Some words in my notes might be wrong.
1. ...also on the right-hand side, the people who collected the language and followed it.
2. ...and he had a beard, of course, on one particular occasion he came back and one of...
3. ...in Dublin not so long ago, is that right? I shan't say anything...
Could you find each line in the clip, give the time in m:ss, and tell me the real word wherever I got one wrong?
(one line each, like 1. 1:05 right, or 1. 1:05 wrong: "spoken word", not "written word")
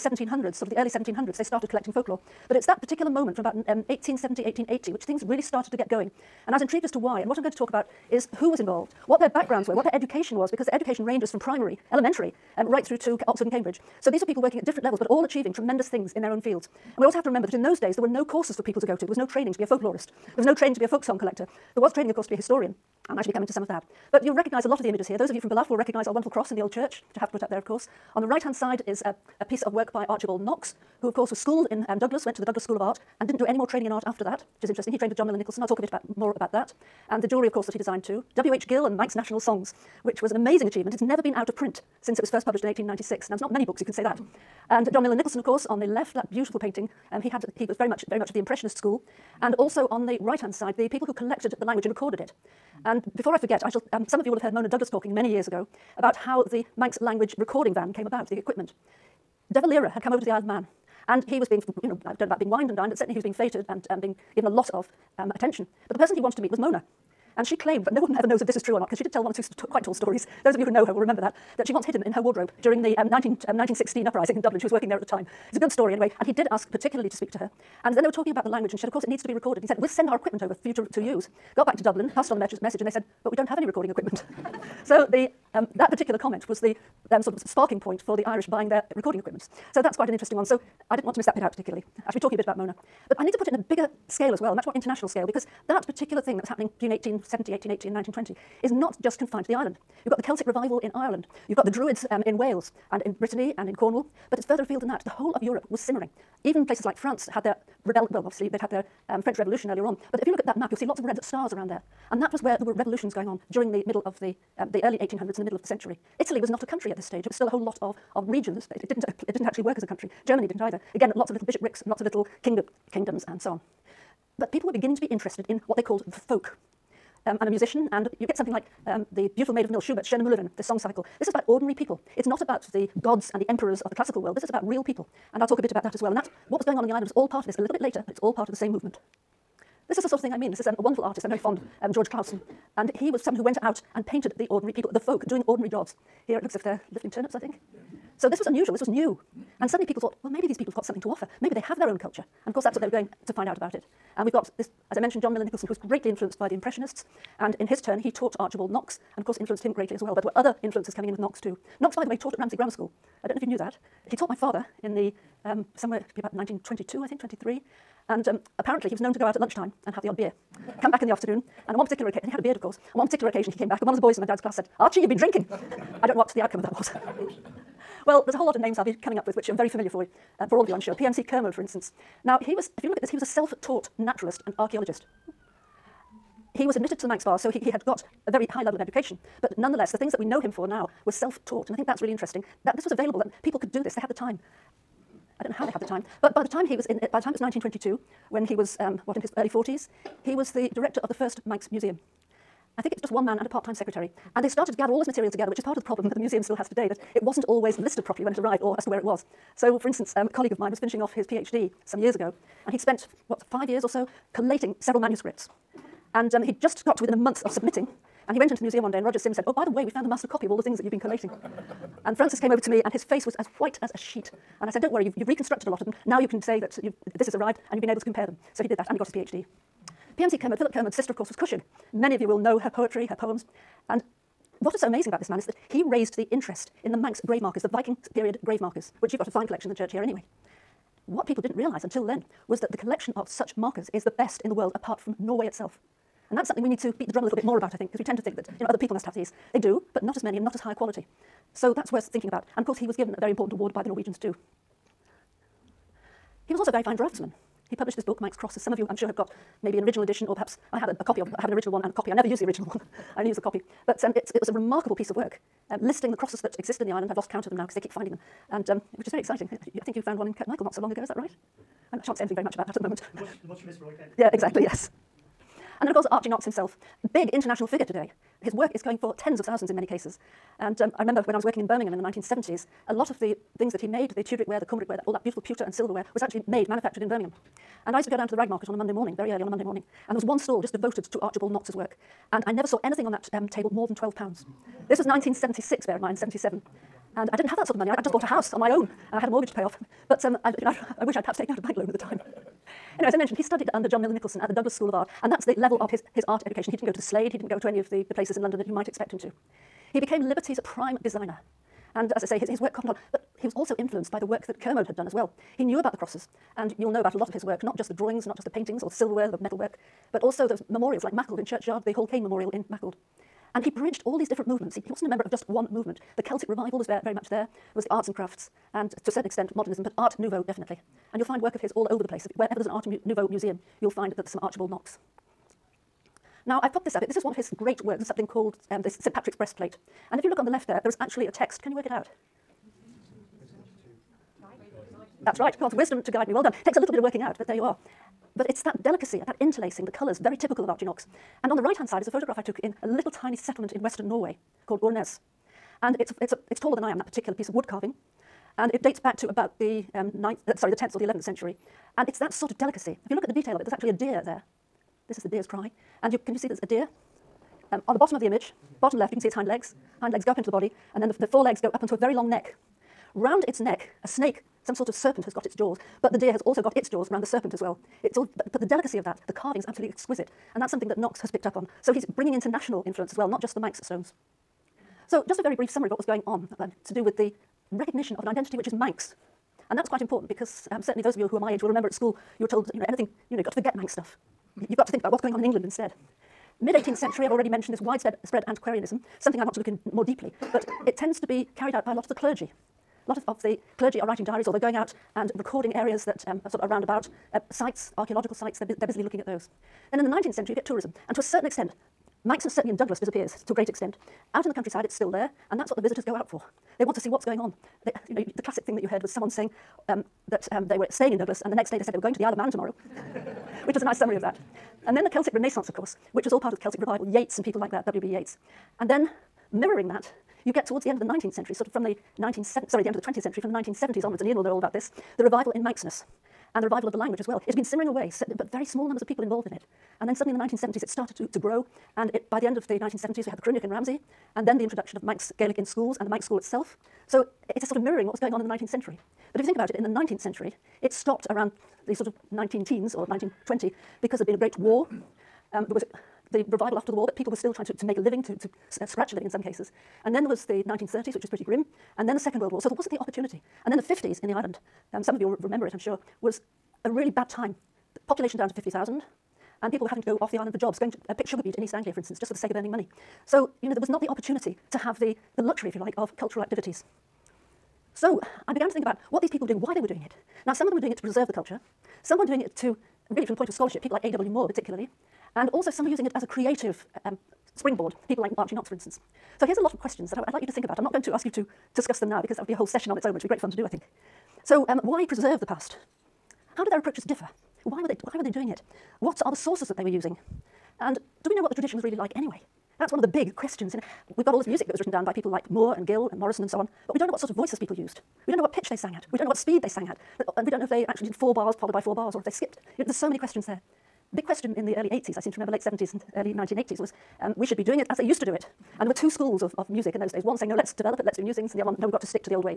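1. 0:49 wrong: "recorded", not "followed"
2. 2:52 right
3. 4:30 wrong: "Kirkmichael", not "Dublin".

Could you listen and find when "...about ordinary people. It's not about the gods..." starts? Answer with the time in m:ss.
2:11.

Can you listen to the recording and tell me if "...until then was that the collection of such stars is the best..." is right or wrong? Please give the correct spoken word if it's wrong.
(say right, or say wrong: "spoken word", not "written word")
wrong: "markers", not "stars".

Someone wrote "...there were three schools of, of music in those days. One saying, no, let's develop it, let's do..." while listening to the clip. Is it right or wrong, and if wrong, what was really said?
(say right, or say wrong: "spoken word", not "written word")
wrong: "two", not "three".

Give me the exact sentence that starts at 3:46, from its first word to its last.
Now you can say that you this has arrived and you've been able to compare them.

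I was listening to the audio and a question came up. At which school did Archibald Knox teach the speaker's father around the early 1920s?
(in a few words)
Ramsey Grammar School.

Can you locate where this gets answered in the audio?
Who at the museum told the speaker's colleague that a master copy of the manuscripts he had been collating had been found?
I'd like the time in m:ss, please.
3:39.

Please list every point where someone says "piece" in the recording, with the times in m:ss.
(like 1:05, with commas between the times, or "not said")
0:29, 4:24, 5:57.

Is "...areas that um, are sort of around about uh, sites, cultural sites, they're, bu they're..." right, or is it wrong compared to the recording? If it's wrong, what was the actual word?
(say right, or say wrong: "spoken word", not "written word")
wrong: "archaeological", not "cultural".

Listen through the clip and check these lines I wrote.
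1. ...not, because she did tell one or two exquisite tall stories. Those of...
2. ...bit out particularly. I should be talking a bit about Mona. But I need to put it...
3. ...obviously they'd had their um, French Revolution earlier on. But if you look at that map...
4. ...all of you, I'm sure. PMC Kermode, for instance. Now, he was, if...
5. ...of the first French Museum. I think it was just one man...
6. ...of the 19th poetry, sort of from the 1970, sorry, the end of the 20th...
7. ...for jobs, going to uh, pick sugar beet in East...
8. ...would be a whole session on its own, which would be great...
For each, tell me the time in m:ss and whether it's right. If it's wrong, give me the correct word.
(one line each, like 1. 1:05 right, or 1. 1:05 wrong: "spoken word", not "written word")
1. 1:08 wrong: "quite", not "exquisite"
2. 1:31 right
3. 1:48 right
4. 3:00 right
5. 3:21 wrong: "Manx", not "French"
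6. 7:10 wrong: "century", not "poetry"
7. 7:50 right
8. 8:12 right.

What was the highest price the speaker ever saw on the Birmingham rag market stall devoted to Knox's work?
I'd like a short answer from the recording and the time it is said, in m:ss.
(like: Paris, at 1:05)
12 pounds, at 4:53.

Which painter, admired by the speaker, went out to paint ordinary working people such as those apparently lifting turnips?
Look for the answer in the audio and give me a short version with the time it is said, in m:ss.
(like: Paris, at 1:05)
George Clausen, at 2:21.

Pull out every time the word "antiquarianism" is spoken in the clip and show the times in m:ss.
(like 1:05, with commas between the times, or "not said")
6:38.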